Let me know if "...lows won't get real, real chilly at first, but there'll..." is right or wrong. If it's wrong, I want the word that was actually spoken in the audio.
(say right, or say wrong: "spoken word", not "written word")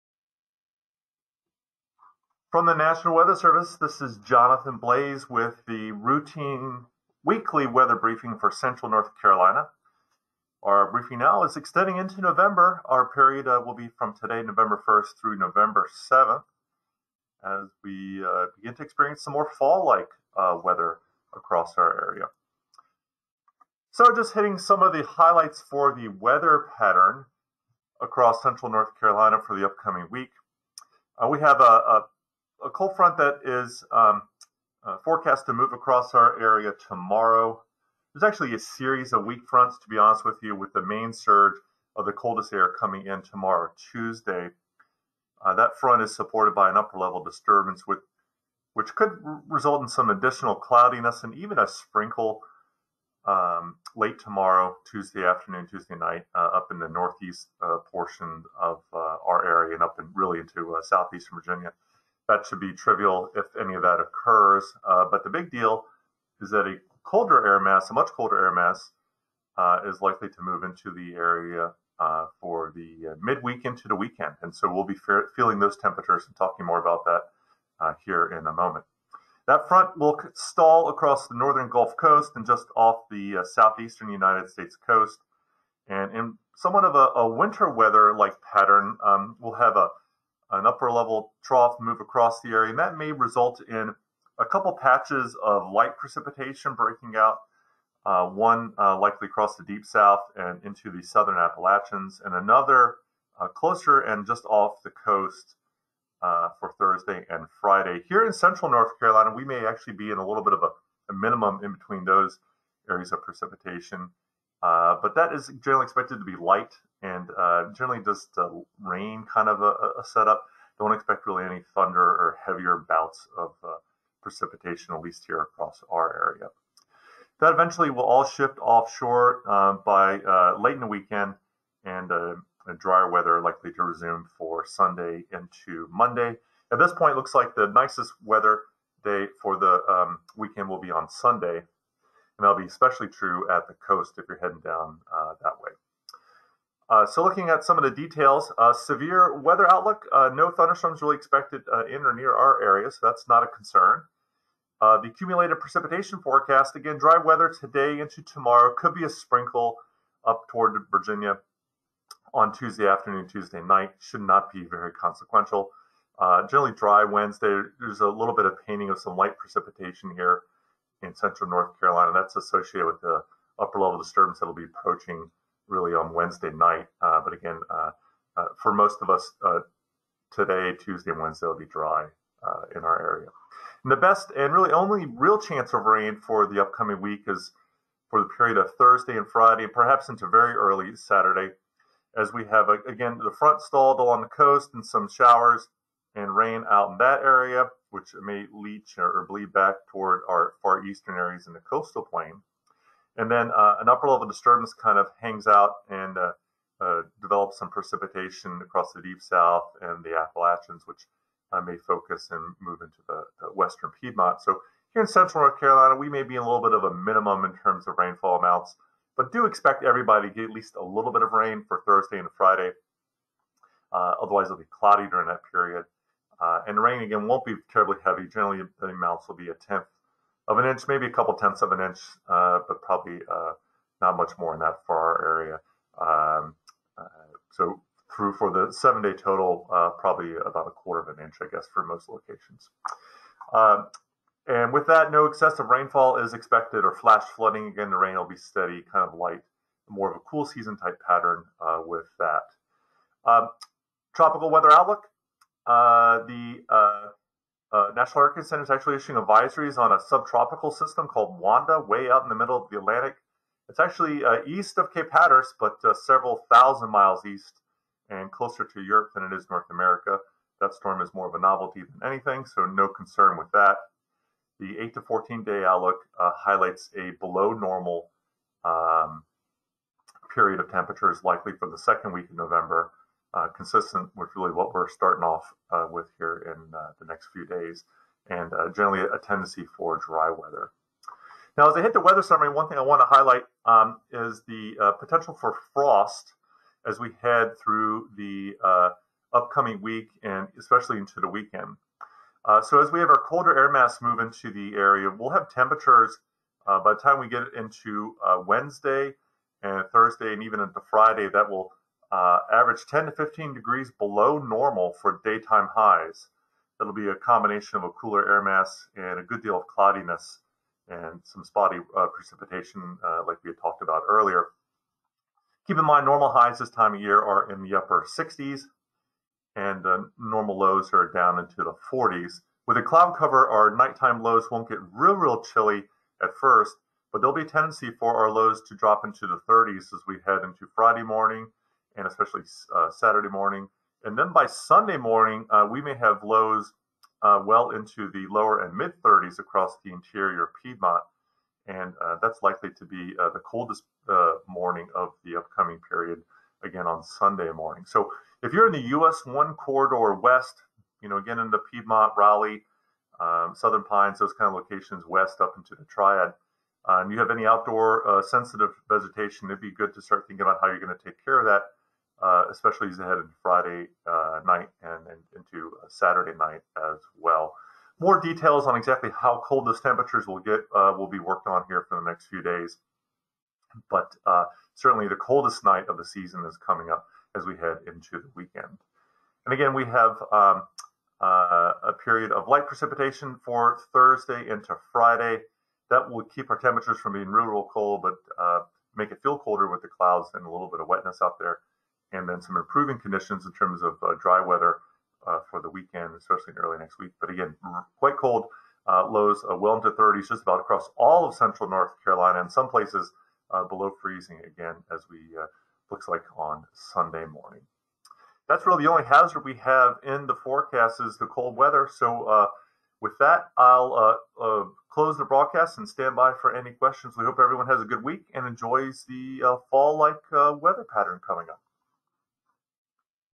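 right.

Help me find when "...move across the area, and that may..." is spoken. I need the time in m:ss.
1:31.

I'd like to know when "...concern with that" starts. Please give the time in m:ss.
4:32.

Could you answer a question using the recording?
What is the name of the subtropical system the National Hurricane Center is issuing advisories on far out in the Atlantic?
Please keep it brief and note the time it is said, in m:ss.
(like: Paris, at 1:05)
Wanda, at 4:21.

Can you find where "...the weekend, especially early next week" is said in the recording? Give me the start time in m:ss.
6:45.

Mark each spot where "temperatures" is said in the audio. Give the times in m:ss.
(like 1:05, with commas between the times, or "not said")
1:15, 4:40, 5:05, 6:19, 6:36.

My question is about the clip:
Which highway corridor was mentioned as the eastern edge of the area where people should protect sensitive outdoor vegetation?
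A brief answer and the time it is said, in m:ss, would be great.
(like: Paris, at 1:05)
US 1, at 5:58.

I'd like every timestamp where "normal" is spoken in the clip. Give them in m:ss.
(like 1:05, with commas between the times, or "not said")
4:37, 5:14, 5:26, 5:30.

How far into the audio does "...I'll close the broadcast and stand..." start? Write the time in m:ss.
7:03.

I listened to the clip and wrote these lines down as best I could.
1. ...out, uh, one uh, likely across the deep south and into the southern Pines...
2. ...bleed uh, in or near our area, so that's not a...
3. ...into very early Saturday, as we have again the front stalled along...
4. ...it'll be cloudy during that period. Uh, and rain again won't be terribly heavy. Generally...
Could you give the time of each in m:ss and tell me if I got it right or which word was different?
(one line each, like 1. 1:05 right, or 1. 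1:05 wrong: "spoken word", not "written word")
1. 1:37 wrong: "Appalachians", not "Pines"
2. 2:31 wrong: "expected", not "bleed"
3. 3:10 right
4. 3:44 right.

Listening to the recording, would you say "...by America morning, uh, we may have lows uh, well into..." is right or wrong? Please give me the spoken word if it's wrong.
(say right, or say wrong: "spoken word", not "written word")
wrong: "Sunday", not "America".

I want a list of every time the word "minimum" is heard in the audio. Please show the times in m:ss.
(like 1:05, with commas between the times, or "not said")
1:51, 3:36.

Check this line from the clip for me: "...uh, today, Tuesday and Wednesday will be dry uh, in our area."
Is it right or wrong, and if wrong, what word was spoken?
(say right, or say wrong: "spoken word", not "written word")
right.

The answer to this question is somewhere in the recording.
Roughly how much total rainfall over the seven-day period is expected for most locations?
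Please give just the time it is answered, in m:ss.
4:00.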